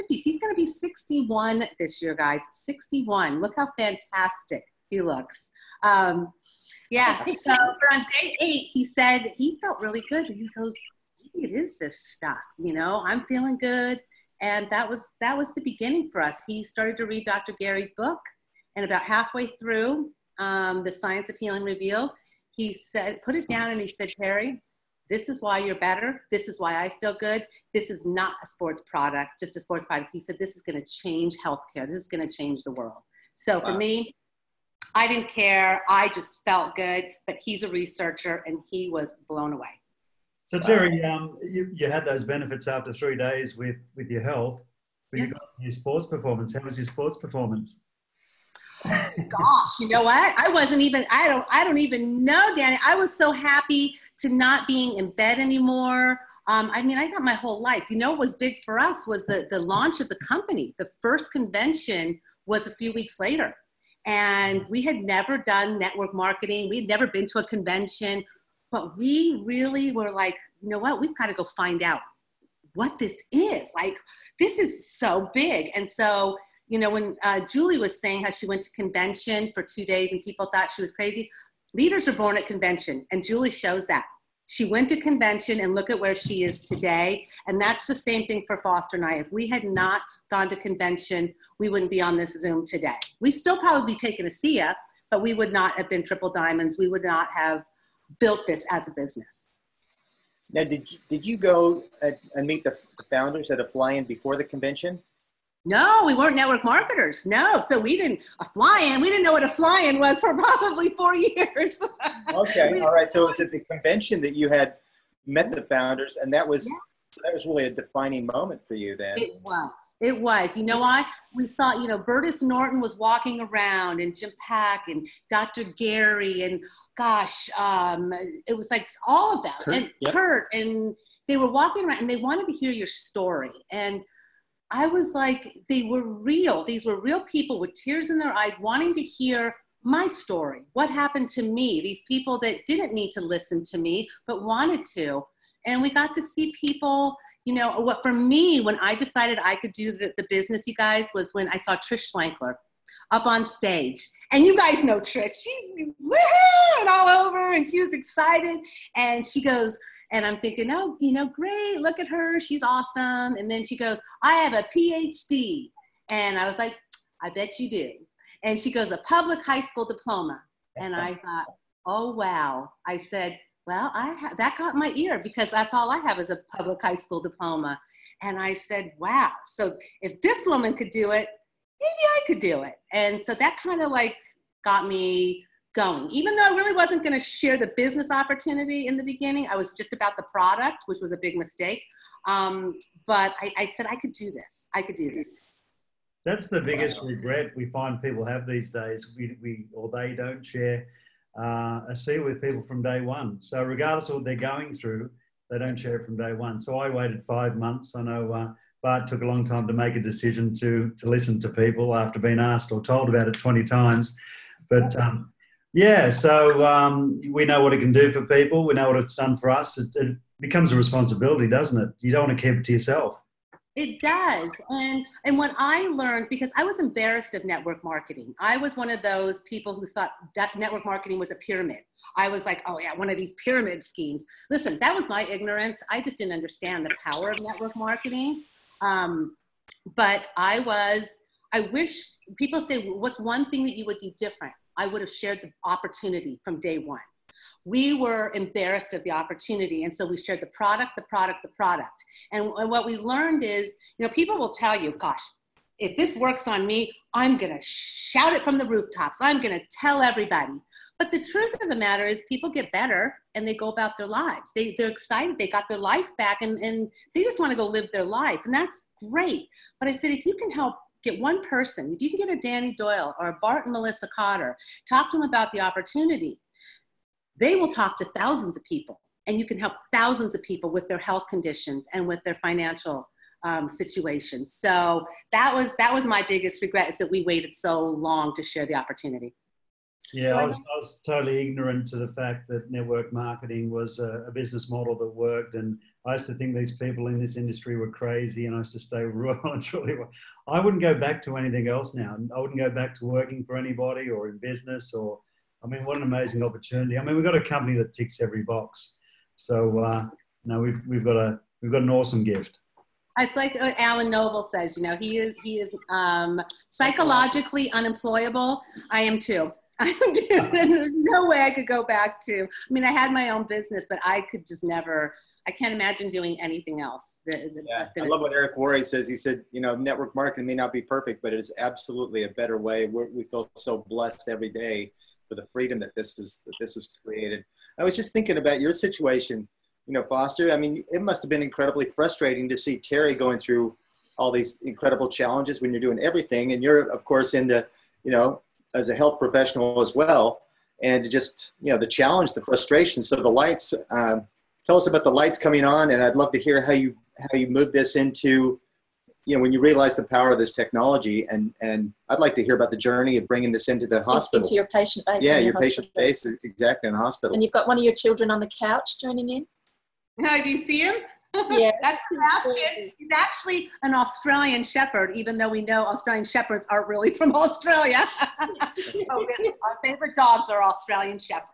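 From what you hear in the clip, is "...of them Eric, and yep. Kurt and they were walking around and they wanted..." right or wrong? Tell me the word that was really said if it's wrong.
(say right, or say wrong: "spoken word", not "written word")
wrong: "Kurt", not "Eric".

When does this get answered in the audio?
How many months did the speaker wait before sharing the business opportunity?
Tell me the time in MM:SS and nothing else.
03:27.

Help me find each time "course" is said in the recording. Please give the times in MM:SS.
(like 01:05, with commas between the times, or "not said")
05:47.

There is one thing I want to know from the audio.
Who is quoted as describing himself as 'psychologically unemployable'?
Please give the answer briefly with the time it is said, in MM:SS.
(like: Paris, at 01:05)
Alan Noble, at 05:13.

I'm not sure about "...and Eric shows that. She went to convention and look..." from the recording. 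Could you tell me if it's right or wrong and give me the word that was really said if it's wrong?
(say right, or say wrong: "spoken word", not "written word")
wrong: "Julie", not "Eric".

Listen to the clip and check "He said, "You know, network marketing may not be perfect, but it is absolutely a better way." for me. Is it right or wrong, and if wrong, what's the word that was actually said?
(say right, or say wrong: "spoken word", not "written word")
right.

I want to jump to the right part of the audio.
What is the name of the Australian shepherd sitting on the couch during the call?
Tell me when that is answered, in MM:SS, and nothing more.
06:12.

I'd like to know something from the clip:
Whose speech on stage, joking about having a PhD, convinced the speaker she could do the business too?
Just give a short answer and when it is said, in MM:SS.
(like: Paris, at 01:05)
Trish Schlenkler, at 02:31.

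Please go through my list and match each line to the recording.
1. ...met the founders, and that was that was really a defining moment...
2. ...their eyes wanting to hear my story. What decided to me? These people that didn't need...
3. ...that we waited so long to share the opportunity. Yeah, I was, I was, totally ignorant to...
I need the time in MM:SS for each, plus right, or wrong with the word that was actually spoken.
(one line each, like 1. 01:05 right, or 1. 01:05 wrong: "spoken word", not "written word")
1. 01:55 right
2. 02:18 wrong: "happened", not "decided"
3. 04:46 right.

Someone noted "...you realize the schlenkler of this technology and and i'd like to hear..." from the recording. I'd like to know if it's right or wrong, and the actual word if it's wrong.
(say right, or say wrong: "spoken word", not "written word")
wrong: "power", not "schlenkler".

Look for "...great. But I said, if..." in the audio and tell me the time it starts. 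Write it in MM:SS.
04:29.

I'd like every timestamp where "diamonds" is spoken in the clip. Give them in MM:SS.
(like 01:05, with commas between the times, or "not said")
01:36.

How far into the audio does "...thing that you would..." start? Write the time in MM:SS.
04:03.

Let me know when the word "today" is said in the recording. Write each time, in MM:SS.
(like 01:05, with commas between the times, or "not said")
01:26, 01:32.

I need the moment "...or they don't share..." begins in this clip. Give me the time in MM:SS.
03:19.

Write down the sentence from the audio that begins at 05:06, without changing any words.
I mean, we've got a company that ticks every box.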